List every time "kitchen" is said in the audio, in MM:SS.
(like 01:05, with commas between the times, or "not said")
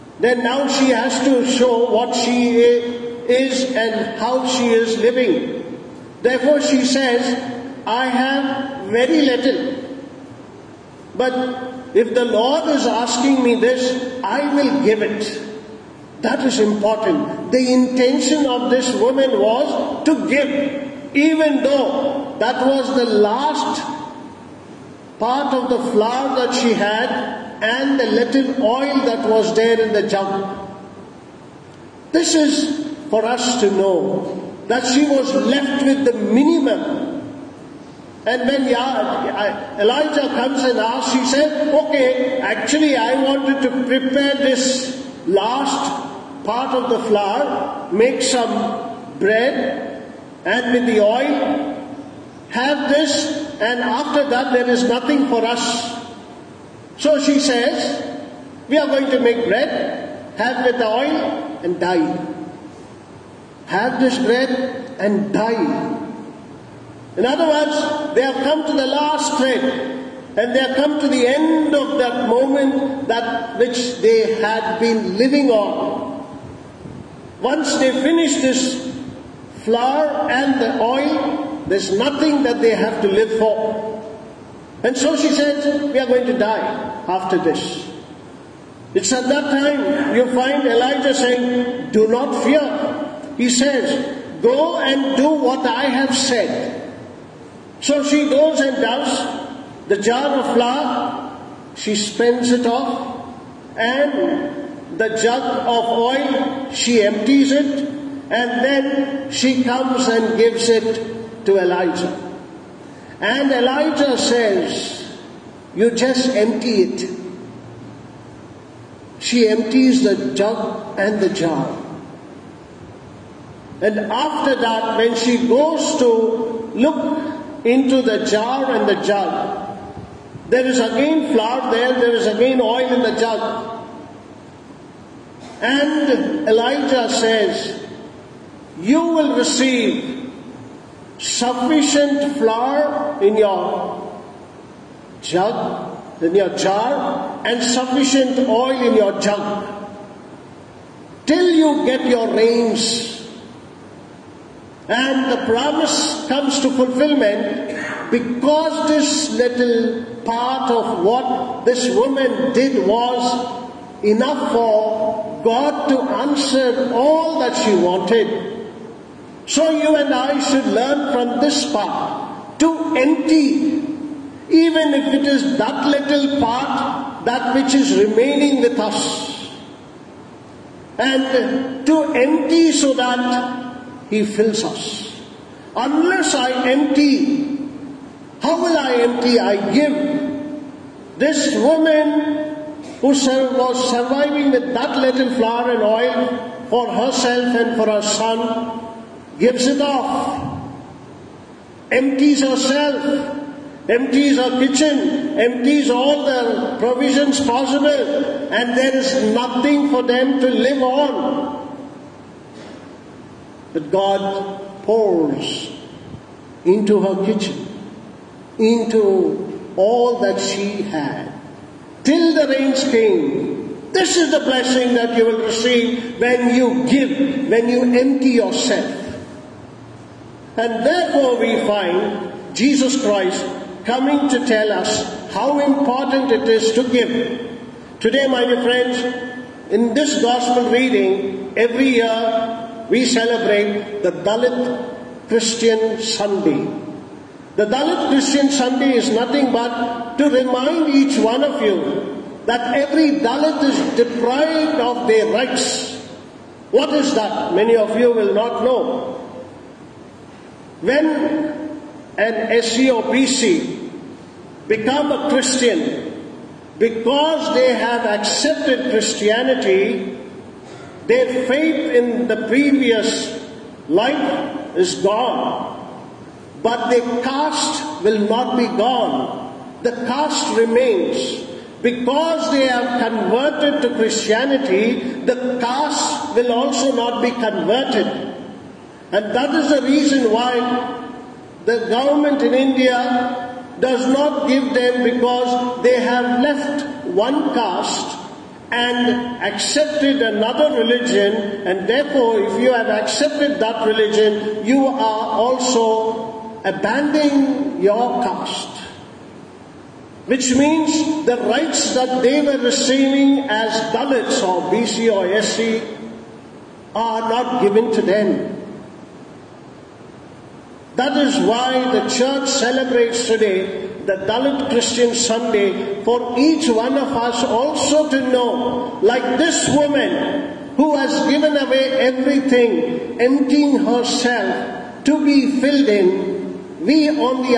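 03:24, 03:37.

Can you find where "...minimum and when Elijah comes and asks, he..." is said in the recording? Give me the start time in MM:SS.
00:36.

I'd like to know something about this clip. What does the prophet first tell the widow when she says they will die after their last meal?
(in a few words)
do not fear.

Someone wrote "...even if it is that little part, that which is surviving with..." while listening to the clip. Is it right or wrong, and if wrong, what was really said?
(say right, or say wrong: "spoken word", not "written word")
wrong: "remaining", not "surviving".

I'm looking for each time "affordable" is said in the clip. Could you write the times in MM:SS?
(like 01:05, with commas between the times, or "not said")
not said.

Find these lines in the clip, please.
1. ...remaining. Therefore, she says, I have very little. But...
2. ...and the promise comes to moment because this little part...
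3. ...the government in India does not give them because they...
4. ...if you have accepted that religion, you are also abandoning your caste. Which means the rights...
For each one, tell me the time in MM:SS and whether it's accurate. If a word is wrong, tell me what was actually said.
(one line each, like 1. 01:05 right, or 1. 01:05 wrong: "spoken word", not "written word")
1. 00:04 wrong: "living", not "remaining"
2. 02:34 wrong: "fulfillment", not "moment"
3. 04:51 right
4. 05:02 right.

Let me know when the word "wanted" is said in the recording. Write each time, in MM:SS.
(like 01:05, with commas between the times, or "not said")
00:43, 02:47.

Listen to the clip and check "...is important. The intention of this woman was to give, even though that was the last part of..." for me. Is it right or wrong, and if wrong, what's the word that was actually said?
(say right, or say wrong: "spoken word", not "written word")
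right.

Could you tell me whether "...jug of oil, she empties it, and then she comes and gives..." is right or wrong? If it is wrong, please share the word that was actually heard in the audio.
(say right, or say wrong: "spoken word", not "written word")
right.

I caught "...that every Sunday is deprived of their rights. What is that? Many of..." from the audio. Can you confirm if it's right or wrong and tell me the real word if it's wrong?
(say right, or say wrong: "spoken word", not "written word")
wrong: "Dalit", not "Sunday".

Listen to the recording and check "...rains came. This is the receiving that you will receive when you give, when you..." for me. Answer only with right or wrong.
wrong.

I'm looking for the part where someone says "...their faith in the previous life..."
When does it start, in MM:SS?
04:31.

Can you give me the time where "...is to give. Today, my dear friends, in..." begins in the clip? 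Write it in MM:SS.
03:56.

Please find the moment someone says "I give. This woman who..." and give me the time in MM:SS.
03:09.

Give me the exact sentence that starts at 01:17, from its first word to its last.
Once they finish this flour and the oil, there's nothing that they have to live for.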